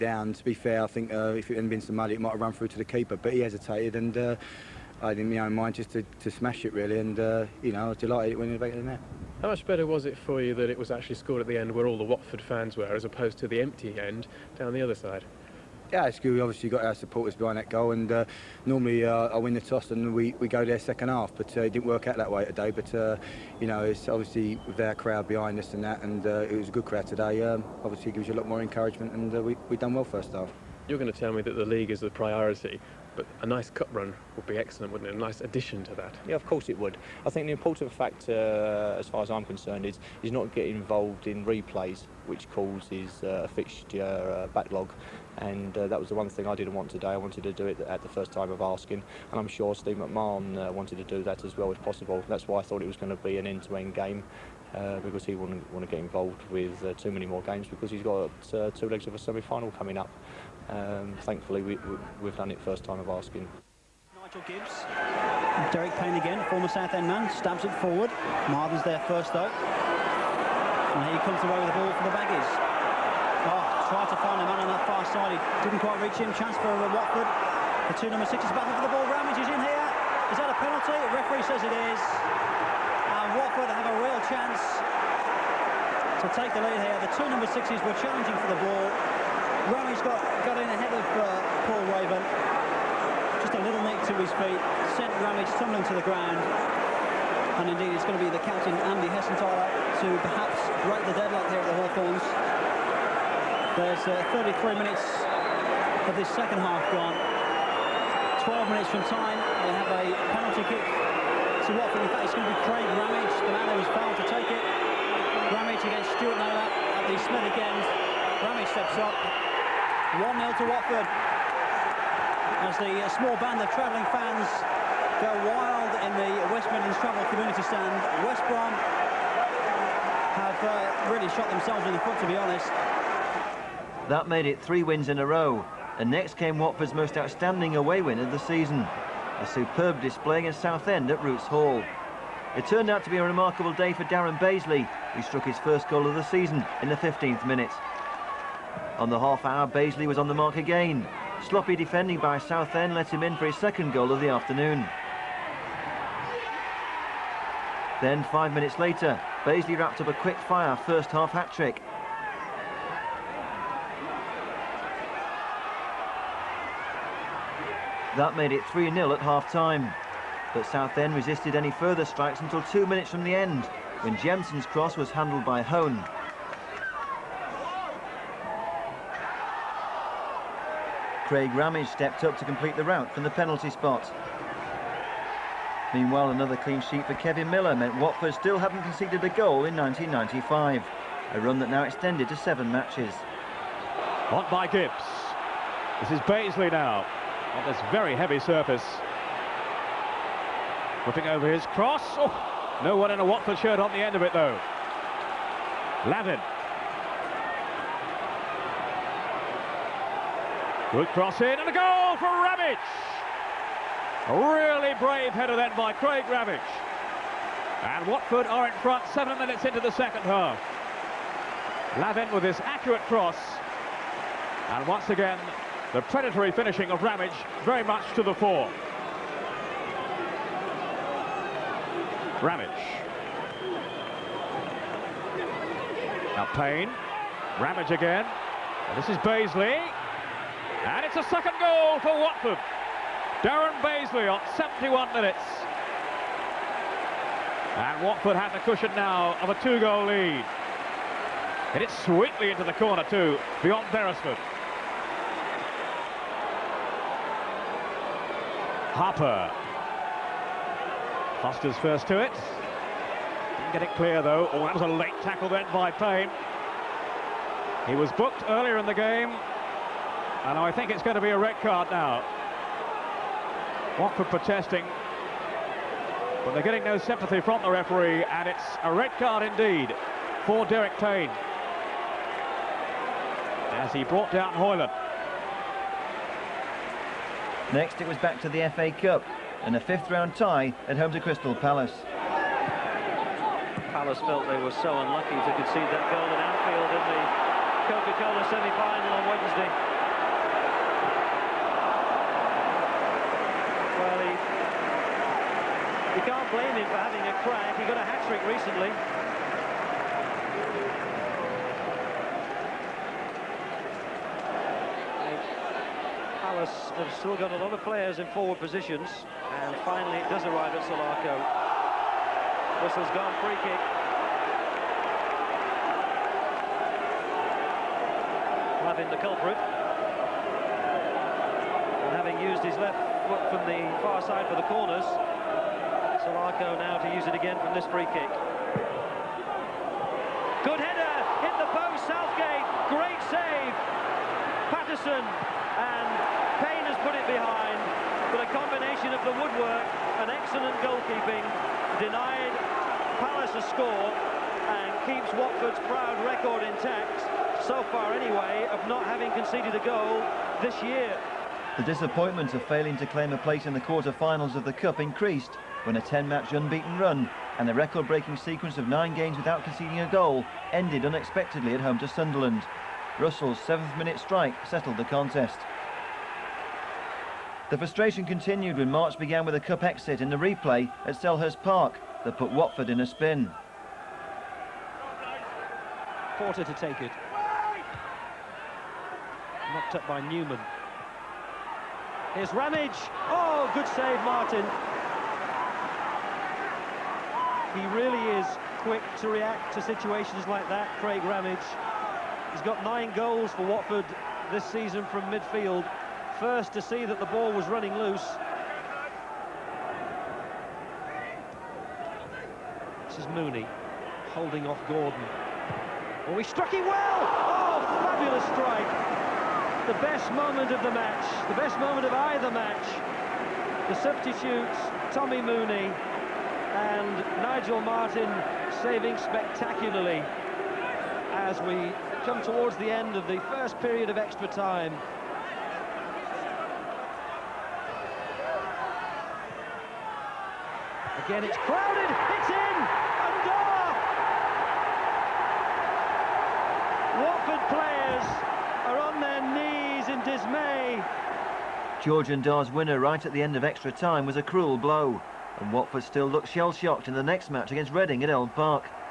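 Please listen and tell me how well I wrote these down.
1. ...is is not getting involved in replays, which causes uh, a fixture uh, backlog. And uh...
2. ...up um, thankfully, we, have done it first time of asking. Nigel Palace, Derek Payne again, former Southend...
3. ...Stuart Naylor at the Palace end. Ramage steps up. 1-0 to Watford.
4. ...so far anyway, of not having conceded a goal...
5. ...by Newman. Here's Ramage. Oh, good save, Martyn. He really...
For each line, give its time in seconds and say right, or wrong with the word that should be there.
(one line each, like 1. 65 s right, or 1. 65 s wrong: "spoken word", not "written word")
1. 39 s right
2. 59 s wrong: "Gibbs", not "Palace"
3. 116 s wrong: "Smith", not "Palace"
4. 357 s right
5. 390 s right.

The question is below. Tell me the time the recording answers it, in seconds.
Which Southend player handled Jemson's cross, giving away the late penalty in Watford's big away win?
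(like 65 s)
175 s.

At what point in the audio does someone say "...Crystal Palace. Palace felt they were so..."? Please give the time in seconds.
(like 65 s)
291 s.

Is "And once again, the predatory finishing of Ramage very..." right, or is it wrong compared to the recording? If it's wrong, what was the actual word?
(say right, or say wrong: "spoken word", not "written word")
right.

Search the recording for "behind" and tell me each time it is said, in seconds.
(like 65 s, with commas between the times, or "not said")
17 s, 25 s, 347 s.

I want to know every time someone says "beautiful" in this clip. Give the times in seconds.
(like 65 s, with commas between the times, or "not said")
not said.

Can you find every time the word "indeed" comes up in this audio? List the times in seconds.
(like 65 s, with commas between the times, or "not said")
97 s, 279 s.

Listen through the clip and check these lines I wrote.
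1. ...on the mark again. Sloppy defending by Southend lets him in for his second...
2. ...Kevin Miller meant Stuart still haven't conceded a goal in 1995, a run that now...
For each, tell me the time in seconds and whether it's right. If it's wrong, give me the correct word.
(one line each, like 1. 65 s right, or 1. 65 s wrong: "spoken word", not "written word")
1. 150 s right
2. 187 s wrong: "Watford", not "Stuart".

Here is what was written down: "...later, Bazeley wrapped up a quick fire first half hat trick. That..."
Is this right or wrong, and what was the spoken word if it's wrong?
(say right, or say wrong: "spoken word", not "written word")
right.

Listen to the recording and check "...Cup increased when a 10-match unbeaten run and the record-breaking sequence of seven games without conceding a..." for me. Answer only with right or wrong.
wrong.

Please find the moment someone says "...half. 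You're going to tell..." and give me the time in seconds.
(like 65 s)
30 s.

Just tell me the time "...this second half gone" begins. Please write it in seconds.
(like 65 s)
106 s.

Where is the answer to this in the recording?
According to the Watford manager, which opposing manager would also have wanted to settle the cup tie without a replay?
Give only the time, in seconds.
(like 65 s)
49 s.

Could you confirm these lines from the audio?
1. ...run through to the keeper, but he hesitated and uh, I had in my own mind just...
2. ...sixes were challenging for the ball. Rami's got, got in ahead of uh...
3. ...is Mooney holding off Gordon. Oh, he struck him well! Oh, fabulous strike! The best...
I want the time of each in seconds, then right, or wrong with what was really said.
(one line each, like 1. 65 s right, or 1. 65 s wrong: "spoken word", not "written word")
1. 2 s right
2. 87 s right
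3. 413 s right.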